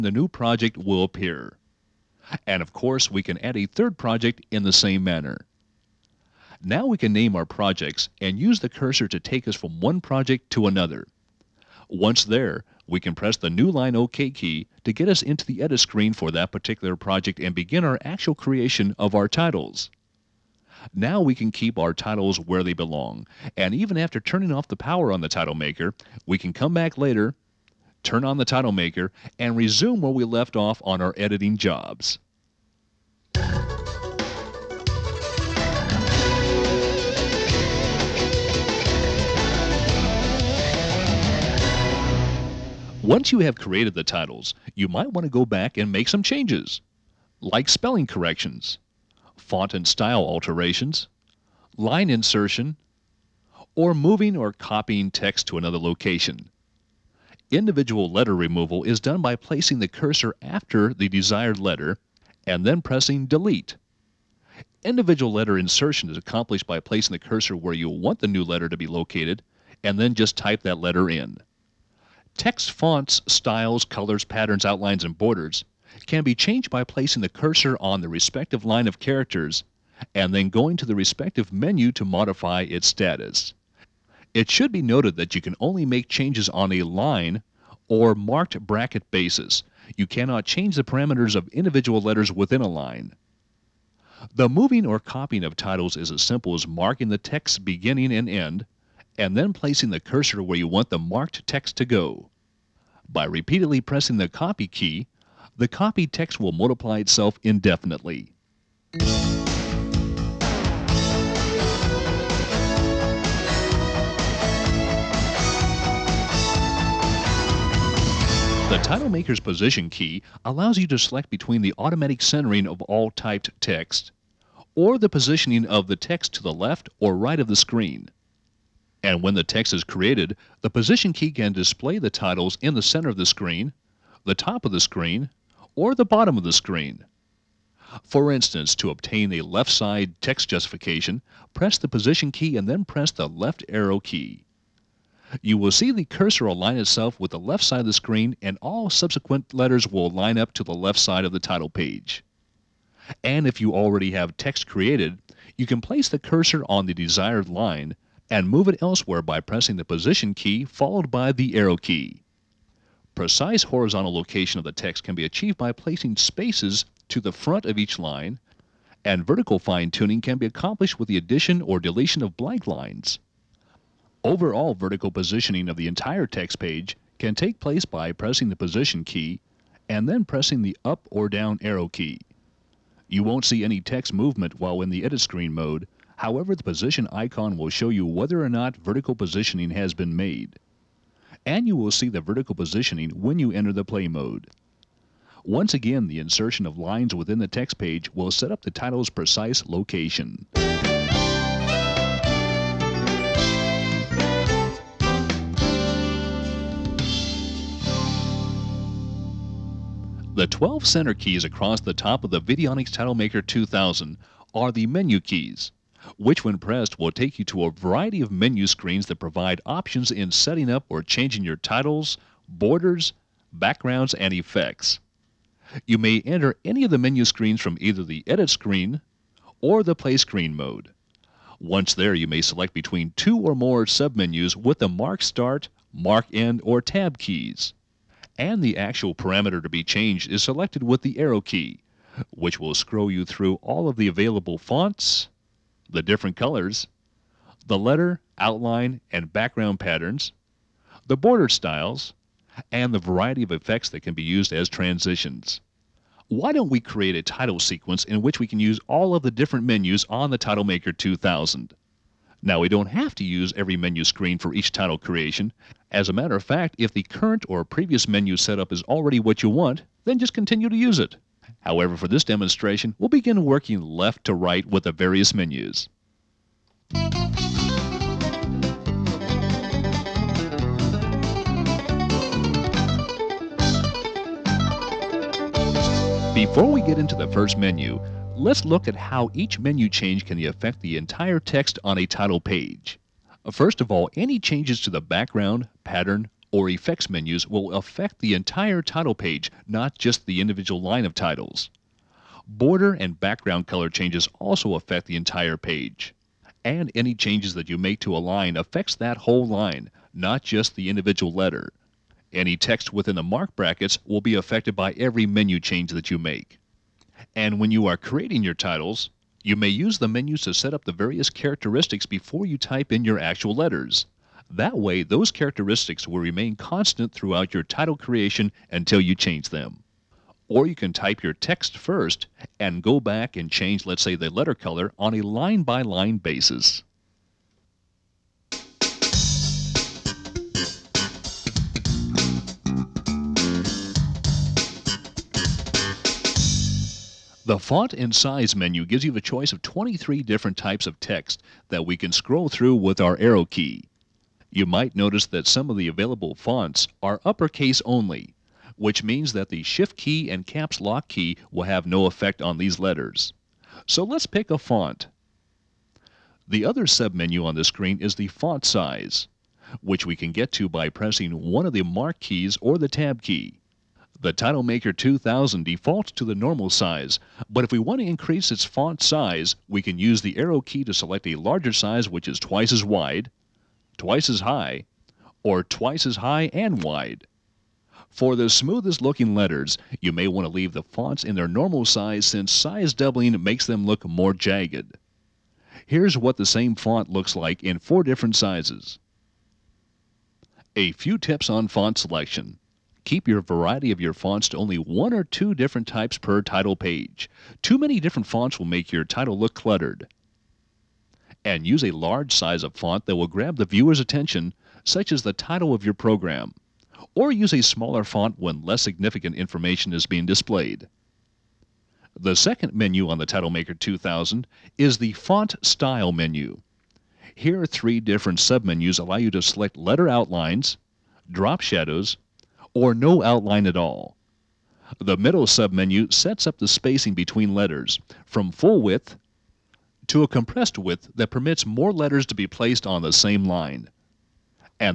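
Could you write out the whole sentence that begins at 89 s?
You cannot change the parameters of individual letters within a line.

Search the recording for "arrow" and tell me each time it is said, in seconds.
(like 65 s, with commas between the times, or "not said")
143 s, 161 s, 181 s, 241 s, 353 s, 380 s.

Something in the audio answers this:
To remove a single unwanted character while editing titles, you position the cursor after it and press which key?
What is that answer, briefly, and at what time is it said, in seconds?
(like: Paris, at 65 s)
Delete, at 63 s.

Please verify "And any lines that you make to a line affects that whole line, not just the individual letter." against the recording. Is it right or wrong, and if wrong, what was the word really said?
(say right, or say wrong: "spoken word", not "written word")
wrong: "changes", not "lines".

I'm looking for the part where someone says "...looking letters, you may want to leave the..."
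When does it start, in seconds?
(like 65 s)
389 s.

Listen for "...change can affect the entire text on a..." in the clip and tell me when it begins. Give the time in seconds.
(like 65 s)
289 s.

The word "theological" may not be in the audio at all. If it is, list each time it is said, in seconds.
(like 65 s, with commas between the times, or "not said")
not said.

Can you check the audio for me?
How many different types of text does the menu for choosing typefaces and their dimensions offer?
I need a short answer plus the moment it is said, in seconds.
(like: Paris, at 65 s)
23, at 349 s.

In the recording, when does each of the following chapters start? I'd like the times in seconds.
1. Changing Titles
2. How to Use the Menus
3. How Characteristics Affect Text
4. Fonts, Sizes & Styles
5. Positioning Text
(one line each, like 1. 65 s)
1. 34 s
2. 203 s
3. 279 s
4. 342 s
5. 111 s.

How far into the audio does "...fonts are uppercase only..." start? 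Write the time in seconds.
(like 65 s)
356 s.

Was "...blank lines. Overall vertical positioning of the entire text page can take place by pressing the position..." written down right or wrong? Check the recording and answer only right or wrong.
right.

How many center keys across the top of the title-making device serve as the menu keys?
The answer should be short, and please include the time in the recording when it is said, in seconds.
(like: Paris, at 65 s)
12, at 210 s.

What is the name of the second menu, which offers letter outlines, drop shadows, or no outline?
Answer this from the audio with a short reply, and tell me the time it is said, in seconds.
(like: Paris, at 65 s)
Font Style menu, at 425 s.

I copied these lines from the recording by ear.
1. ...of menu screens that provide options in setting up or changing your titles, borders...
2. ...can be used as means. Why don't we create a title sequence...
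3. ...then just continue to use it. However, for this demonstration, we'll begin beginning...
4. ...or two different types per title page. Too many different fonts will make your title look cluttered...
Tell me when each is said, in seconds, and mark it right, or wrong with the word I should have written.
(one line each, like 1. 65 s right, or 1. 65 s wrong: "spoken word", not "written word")
1. 218 s right
2. 254 s wrong: "transitions", not "means"
3. 270 s wrong: "working", not "beginning"
4. 405 s right.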